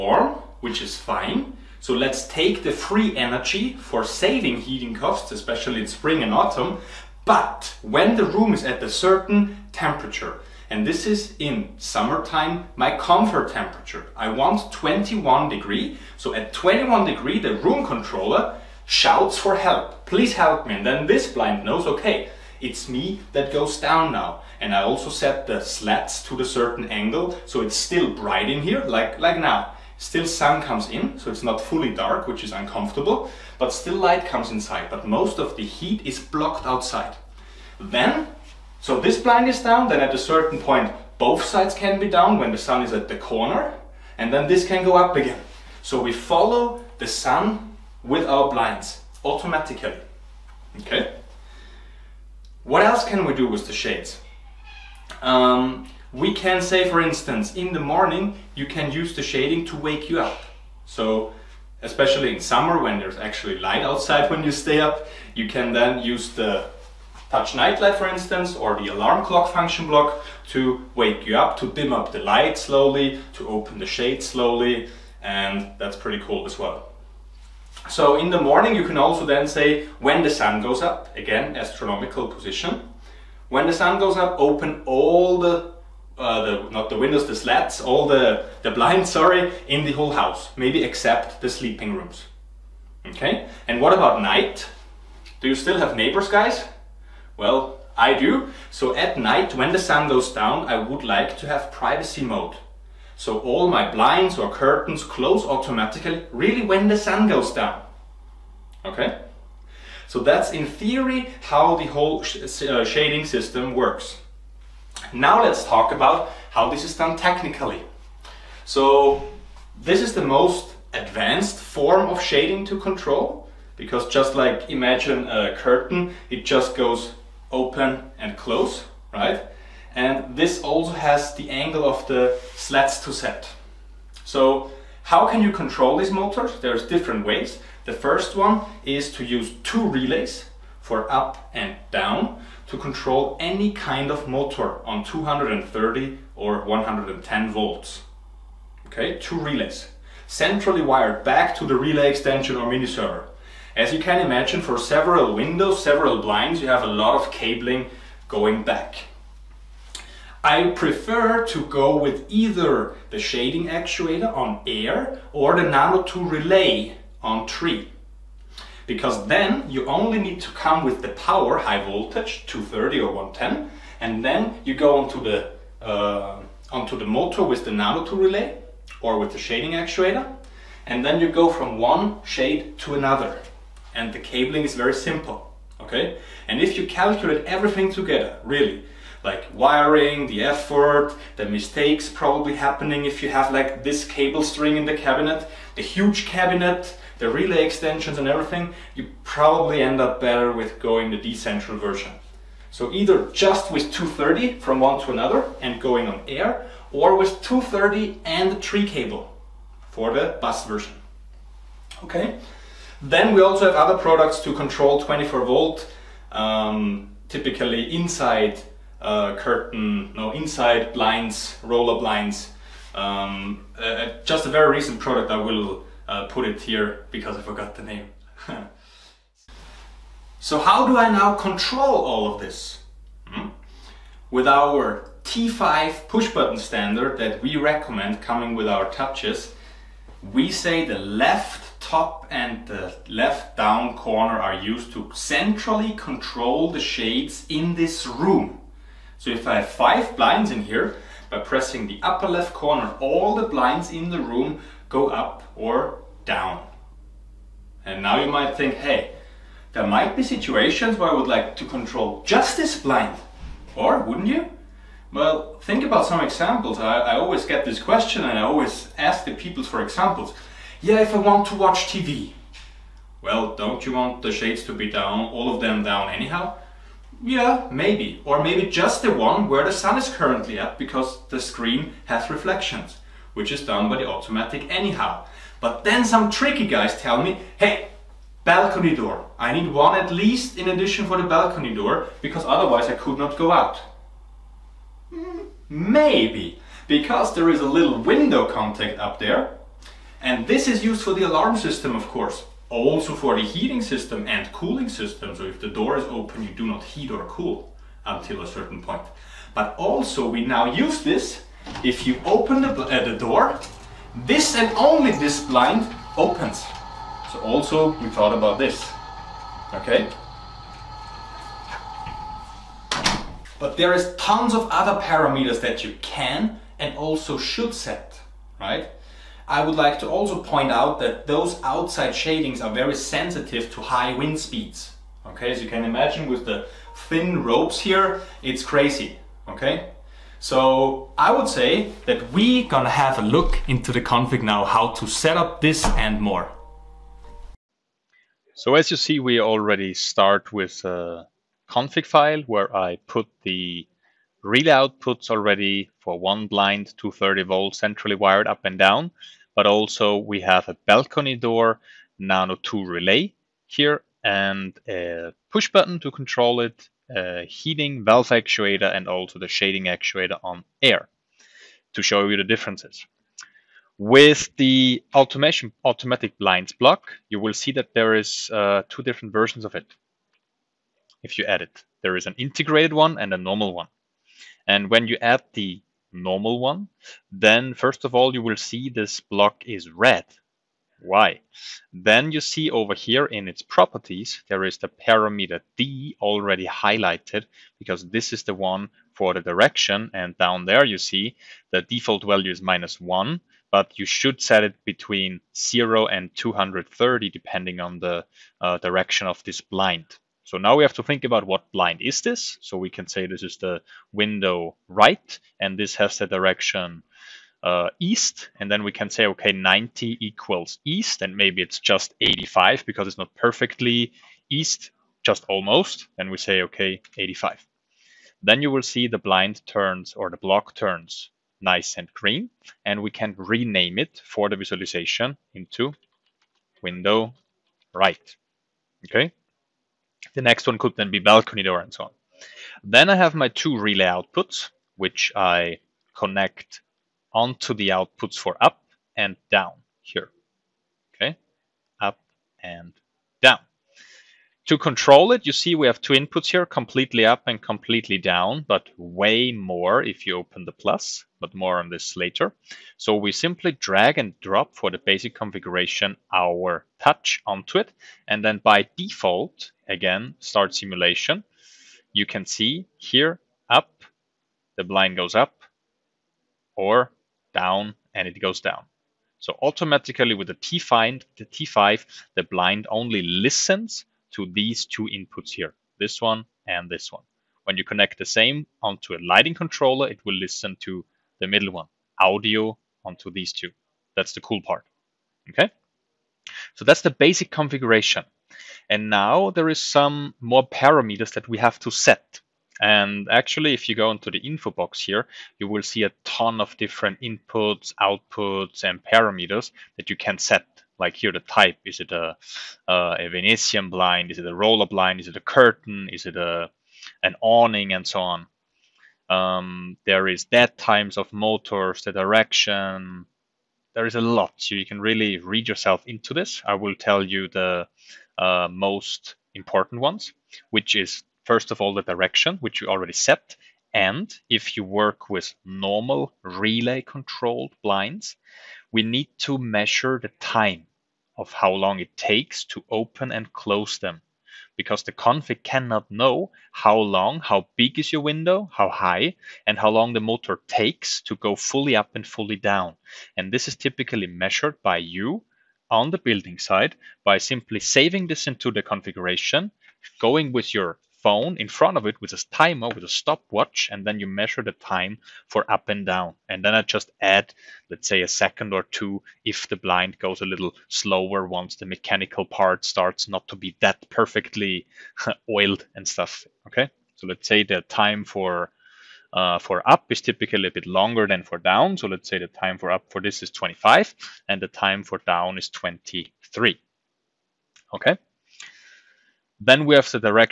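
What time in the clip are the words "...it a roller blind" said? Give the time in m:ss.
8:34.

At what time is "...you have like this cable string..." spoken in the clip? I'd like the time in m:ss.
3:13.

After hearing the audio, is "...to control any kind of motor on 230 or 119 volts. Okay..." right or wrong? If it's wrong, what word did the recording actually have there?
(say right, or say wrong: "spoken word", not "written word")
wrong: "110", not "119".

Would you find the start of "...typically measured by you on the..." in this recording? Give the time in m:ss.
9:13.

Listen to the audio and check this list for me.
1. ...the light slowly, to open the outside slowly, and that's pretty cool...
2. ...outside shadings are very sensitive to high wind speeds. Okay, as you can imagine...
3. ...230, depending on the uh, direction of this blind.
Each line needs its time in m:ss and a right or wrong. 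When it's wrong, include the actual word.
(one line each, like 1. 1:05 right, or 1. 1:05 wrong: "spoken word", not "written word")
1. 1:12 wrong: "shade", not "outside"
2. 5:31 right
3. 6:46 right.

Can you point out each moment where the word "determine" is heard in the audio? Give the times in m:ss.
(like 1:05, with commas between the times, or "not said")
not said.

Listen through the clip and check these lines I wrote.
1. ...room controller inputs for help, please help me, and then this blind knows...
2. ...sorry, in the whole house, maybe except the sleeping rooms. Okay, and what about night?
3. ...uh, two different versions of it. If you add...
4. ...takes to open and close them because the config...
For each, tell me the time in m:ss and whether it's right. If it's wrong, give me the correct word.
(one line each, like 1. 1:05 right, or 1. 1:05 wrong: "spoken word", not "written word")
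1. 0:17 wrong: "shouts", not "inputs"
2. 1:29 right
3. 6:18 right
4. 9:02 right.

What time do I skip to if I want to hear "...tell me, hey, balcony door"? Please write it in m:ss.
4:46.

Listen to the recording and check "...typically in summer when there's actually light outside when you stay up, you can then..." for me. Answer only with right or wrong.
wrong.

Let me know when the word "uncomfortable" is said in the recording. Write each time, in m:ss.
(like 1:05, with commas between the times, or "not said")
0:32.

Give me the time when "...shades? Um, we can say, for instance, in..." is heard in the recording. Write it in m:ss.
0:53.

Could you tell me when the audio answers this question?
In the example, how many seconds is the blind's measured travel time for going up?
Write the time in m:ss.
9:43.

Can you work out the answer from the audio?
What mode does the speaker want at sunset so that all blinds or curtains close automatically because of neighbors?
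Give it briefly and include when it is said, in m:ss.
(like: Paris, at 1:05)
privacy mode, at 1:41.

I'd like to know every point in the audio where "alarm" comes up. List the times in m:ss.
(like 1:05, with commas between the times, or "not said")
1:08, 5:01.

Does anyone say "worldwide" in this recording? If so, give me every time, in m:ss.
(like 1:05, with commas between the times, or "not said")
not said.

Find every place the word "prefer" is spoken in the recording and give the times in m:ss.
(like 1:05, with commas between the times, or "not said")
2:40.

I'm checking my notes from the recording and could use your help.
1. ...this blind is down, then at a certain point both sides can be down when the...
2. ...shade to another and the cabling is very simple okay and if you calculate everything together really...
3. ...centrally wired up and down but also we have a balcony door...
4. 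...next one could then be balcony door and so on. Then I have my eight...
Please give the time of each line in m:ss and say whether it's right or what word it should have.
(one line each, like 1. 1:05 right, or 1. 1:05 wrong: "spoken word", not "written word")
1. 0:38 right
2. 3:02 right
3. 5:57 right
4. 7:20 wrong: "two", not "eight".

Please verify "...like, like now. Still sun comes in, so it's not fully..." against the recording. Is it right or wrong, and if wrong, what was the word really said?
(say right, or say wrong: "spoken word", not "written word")
right.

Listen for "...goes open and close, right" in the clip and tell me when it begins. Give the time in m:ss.
2:06.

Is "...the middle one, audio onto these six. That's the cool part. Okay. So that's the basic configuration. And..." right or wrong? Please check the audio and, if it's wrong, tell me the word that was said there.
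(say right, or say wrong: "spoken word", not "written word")
wrong: "two", not "six".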